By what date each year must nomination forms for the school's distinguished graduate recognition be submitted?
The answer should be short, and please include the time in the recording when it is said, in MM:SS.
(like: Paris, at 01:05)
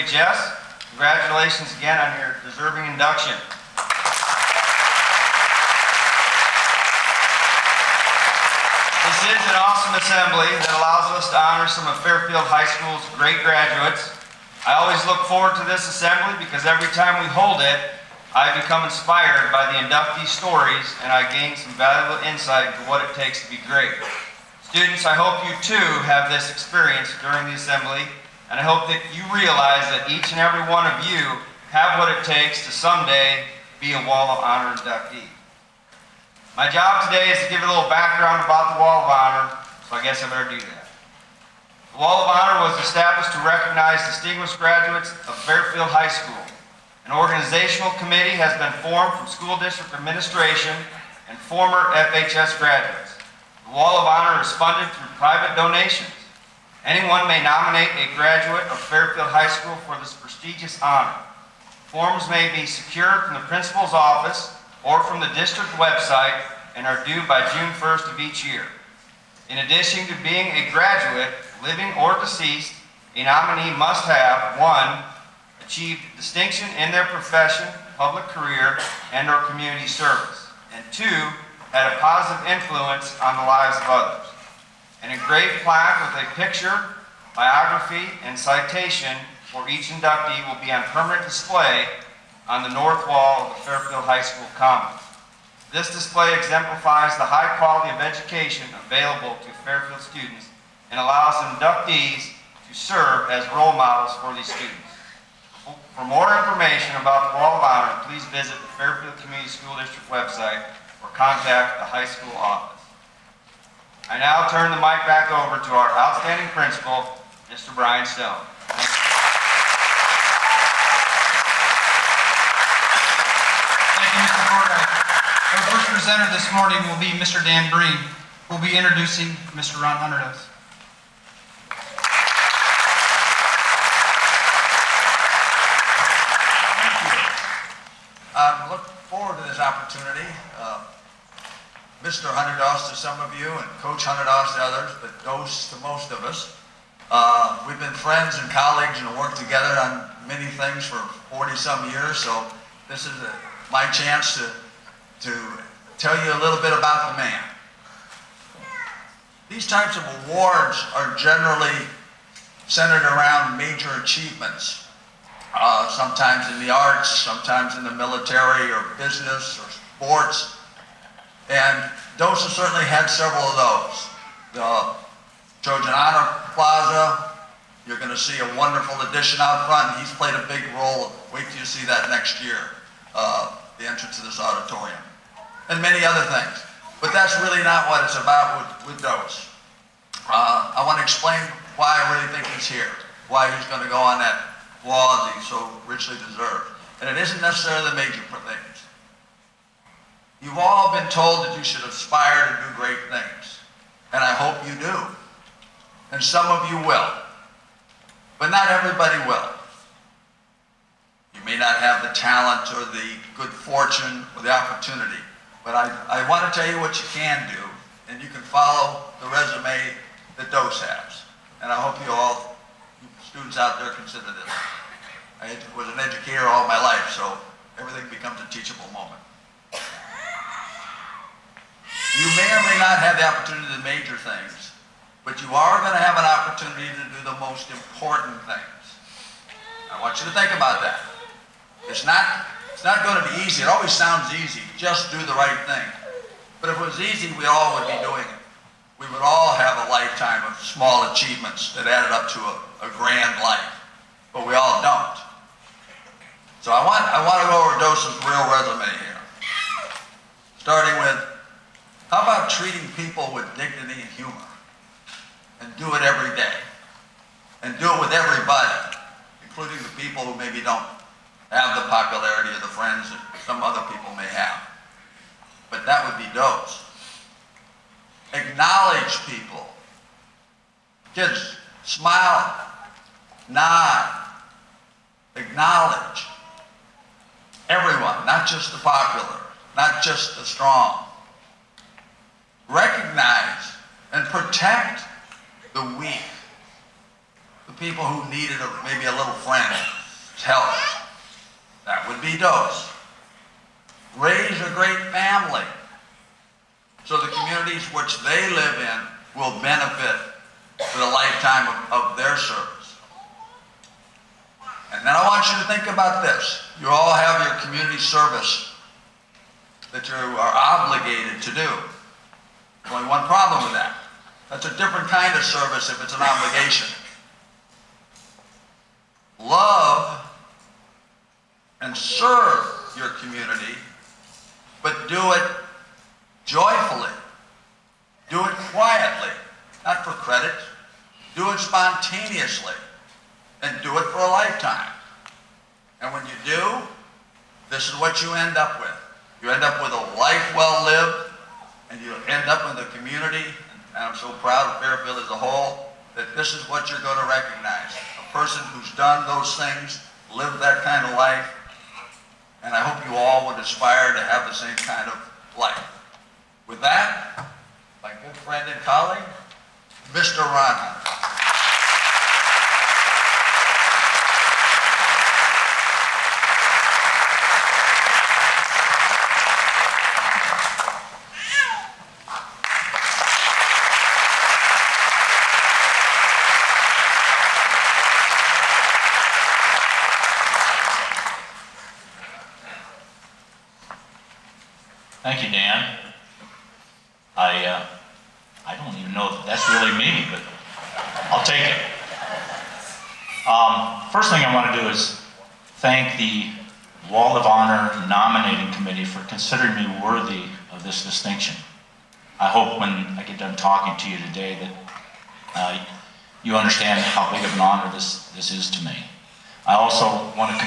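June 1st, at 01:07.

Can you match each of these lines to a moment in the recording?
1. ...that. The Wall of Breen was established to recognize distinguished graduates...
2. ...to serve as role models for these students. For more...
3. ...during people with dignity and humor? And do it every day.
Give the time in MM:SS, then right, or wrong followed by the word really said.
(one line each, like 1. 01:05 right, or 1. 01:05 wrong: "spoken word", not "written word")
1. 00:40 wrong: "Honor", not "Breen"
2. 01:42 right
3. 04:22 wrong: "treating", not "during".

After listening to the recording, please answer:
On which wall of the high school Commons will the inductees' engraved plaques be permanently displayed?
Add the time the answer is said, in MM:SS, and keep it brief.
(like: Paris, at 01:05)
north wall, at 01:32.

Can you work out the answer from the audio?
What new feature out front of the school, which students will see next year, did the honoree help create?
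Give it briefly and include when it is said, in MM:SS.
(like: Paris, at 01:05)
Trojan Honor Plaza, at 02:55.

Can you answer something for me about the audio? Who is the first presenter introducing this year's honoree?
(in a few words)
Dan Breen.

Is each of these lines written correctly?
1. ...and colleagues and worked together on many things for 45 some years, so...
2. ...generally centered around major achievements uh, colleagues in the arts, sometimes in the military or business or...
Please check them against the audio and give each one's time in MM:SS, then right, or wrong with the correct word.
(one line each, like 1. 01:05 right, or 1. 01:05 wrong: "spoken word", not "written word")
1. 02:28 wrong: "40", not "45"
2. 02:41 wrong: "sometimes", not "colleagues".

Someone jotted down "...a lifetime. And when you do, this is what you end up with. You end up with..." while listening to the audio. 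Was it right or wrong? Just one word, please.
right.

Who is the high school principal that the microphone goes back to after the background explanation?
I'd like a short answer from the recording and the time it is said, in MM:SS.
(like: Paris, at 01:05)
Brian Stone, at 01:57.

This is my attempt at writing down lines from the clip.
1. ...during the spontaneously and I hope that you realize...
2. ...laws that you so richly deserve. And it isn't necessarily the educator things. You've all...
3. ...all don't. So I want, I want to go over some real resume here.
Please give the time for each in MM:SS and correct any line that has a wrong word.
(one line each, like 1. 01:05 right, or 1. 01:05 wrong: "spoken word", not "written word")
1. 00:27 wrong: "assembly", not "spontaneously"
2. 03:14 wrong: "major", not "educator"
3. 04:14 right.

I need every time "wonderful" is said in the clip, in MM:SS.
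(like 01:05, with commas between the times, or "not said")
02:58.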